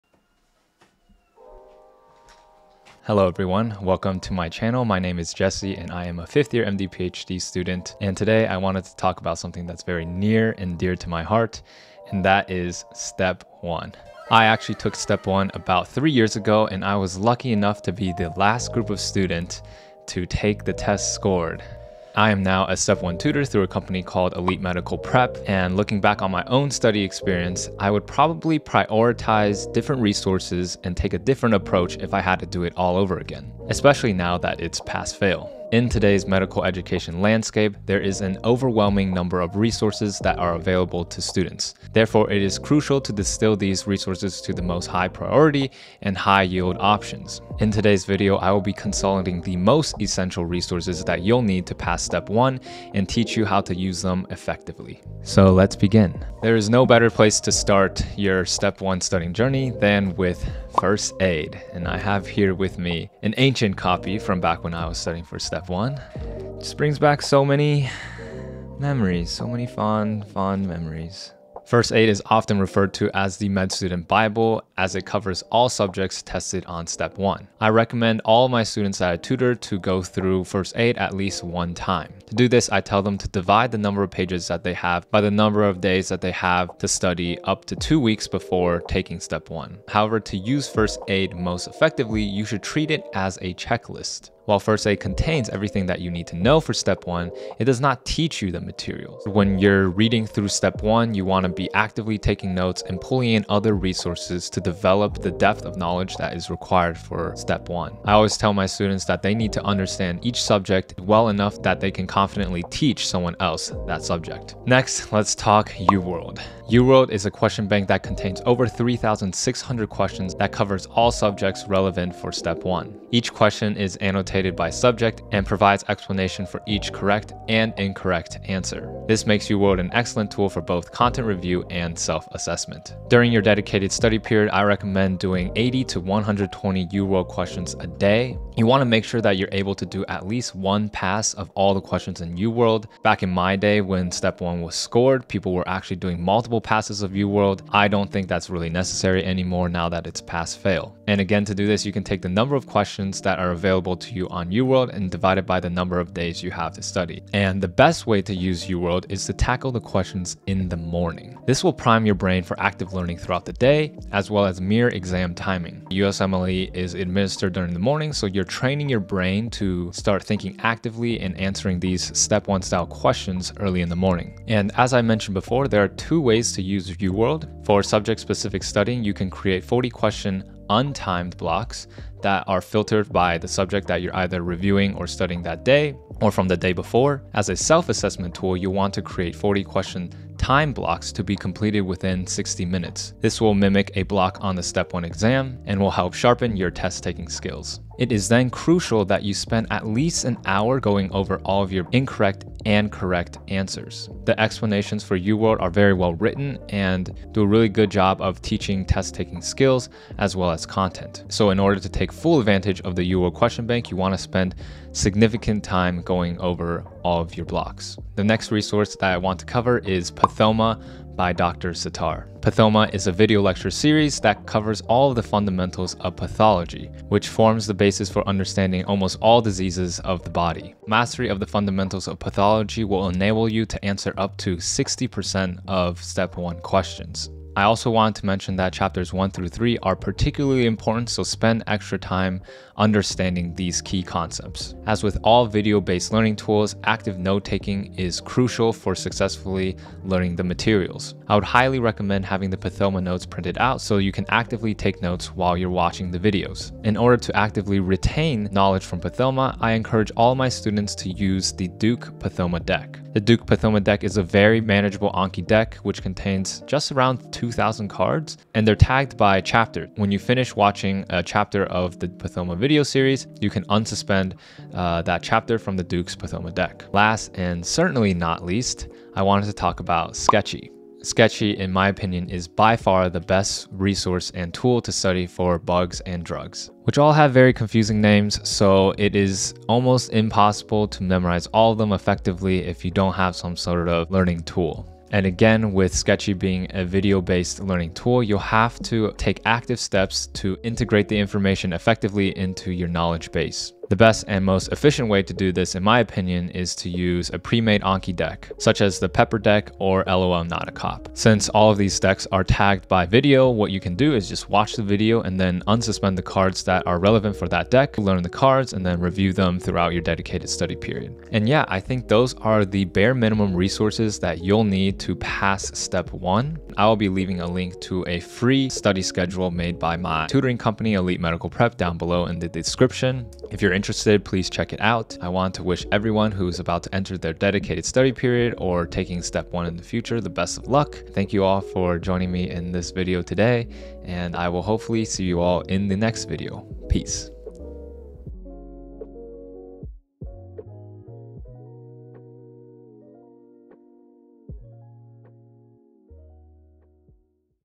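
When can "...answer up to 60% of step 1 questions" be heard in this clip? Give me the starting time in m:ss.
3:53.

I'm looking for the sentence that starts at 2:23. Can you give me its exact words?
Back in my day when step one was scored, people were actually doing multiple passes of UWorld.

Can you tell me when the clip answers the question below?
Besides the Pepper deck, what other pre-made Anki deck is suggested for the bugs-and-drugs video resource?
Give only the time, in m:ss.
5:10.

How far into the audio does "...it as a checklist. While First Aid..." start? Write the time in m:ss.
1:32.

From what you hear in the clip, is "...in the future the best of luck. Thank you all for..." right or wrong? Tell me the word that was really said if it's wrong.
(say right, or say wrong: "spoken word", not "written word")
right.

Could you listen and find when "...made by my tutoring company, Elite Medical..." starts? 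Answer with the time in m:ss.
5:29.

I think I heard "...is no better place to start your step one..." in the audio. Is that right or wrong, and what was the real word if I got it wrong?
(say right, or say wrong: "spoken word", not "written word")
right.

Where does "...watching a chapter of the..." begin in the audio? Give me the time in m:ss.
4:30.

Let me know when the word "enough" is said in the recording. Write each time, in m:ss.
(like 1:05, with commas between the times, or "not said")
0:17, 1:51.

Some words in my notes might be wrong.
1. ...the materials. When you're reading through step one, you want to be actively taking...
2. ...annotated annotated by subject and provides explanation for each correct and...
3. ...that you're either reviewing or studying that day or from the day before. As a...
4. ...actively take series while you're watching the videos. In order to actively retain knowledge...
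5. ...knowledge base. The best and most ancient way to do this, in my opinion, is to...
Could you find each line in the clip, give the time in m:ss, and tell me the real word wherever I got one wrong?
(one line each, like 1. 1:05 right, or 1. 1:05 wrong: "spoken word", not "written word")
1. 1:38 right
2. 2:03 right
3. 3:03 right
4. 4:14 wrong: "notes", not "series"
5. 5:02 wrong: "efficient", not "ancient".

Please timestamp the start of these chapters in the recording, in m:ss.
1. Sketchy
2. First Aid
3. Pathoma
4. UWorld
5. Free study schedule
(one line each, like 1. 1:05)
1. 4:36
2. 0:56
3. 3:37
4. 1:54
5. 5:25.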